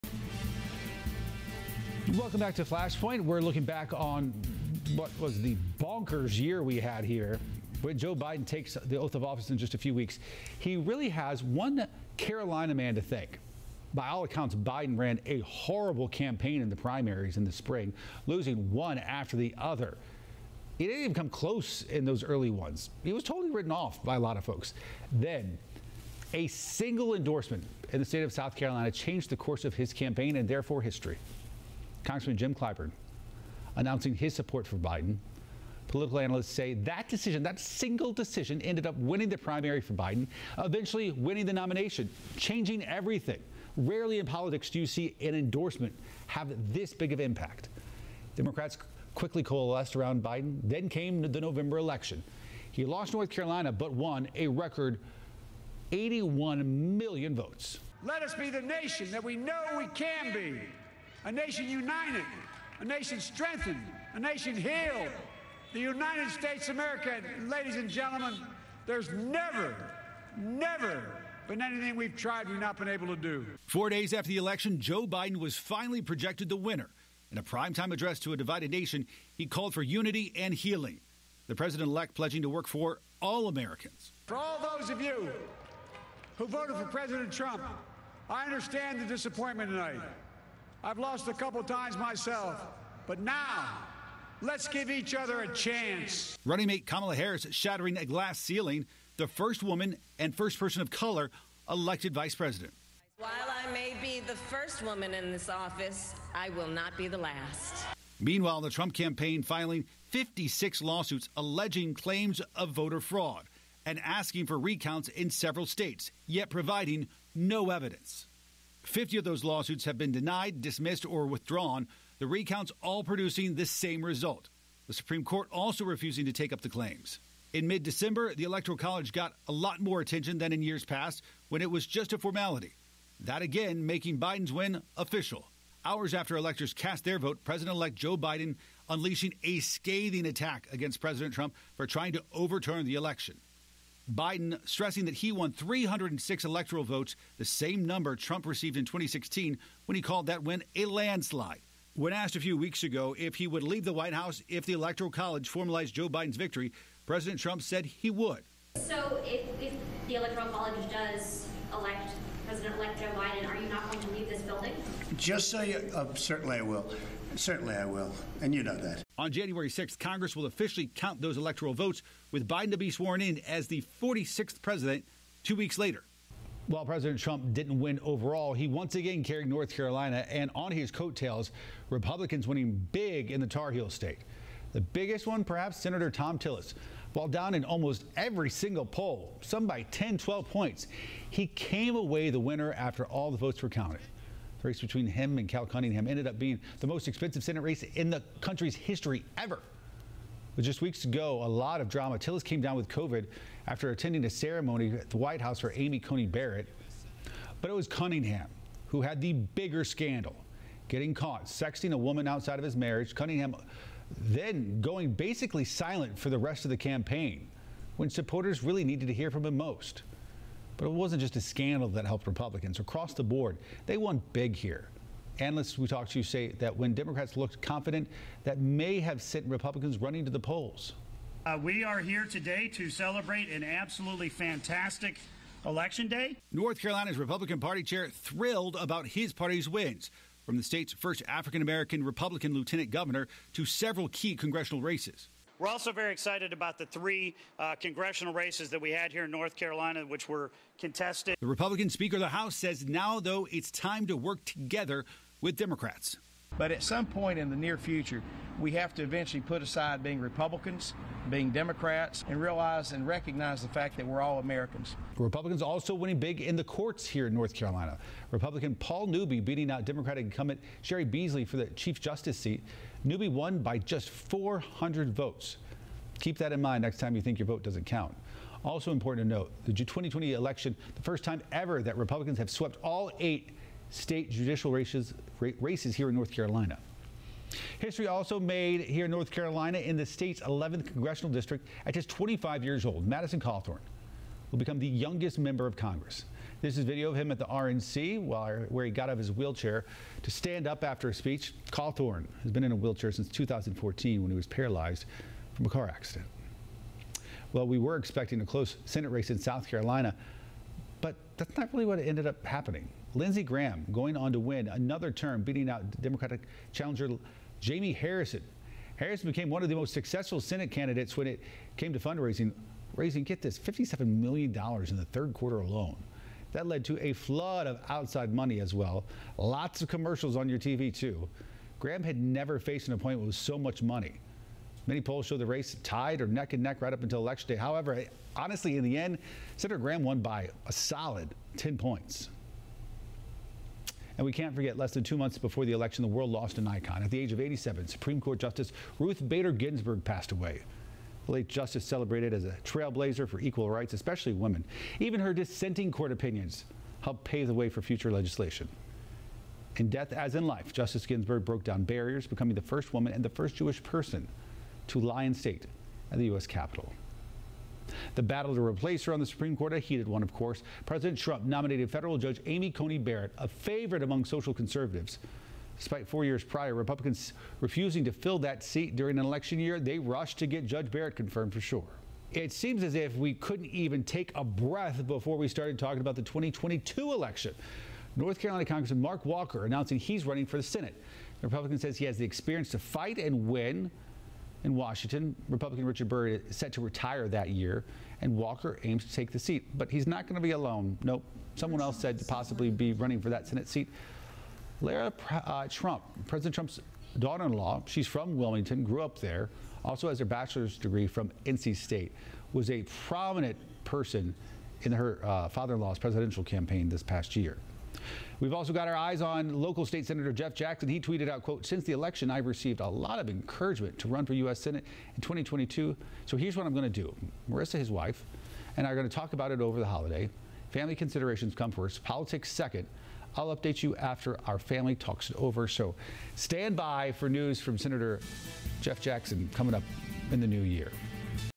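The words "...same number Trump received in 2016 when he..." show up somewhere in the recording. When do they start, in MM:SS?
02:27.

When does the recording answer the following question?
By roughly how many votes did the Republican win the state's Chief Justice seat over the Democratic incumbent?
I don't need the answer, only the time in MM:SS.
04:34.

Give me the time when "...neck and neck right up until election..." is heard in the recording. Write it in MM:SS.
05:36.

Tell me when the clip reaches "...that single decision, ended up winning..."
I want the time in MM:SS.
00:37.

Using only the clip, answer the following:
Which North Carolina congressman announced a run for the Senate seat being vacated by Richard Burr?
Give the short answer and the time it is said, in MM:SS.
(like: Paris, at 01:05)
Mark Walker, at 06:29.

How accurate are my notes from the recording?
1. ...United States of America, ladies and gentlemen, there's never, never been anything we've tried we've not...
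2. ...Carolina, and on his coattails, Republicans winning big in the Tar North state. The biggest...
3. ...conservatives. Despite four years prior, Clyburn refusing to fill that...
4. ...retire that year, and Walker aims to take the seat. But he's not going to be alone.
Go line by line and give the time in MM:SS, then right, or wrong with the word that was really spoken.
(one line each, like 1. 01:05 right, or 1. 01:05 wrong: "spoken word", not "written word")
1. 01:05 right
2. 02:59 wrong: "Heel", not "North"
3. 06:14 wrong: "Republicans", not "Clyburn"
4. 06:36 right.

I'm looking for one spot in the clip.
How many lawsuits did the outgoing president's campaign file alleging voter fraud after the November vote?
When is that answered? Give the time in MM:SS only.
01:50.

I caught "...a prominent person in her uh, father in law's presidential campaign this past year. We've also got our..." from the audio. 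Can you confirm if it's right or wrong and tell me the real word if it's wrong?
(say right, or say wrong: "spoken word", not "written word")
right.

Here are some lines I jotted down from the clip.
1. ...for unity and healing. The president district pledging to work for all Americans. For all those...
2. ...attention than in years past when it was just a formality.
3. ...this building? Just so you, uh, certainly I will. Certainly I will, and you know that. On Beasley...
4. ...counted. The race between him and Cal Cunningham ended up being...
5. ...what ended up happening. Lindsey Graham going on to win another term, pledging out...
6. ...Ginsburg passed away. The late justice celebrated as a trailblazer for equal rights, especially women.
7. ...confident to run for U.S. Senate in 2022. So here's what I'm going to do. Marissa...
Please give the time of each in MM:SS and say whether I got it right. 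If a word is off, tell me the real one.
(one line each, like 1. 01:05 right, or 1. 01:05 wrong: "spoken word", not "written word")
1. 01:19 wrong: "elect", not "district"
2. 02:10 right
3. 02:44 wrong: "January", not "Beasley"
4. 03:13 right
5. 05:11 wrong: "beating", not "pledging"
6. 05:49 right
7. 07:03 wrong: "encouragement", not "confident".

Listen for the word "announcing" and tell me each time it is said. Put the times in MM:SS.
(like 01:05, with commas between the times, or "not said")
00:33, 06:29.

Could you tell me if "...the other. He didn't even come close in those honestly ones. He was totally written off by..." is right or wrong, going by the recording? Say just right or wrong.
wrong.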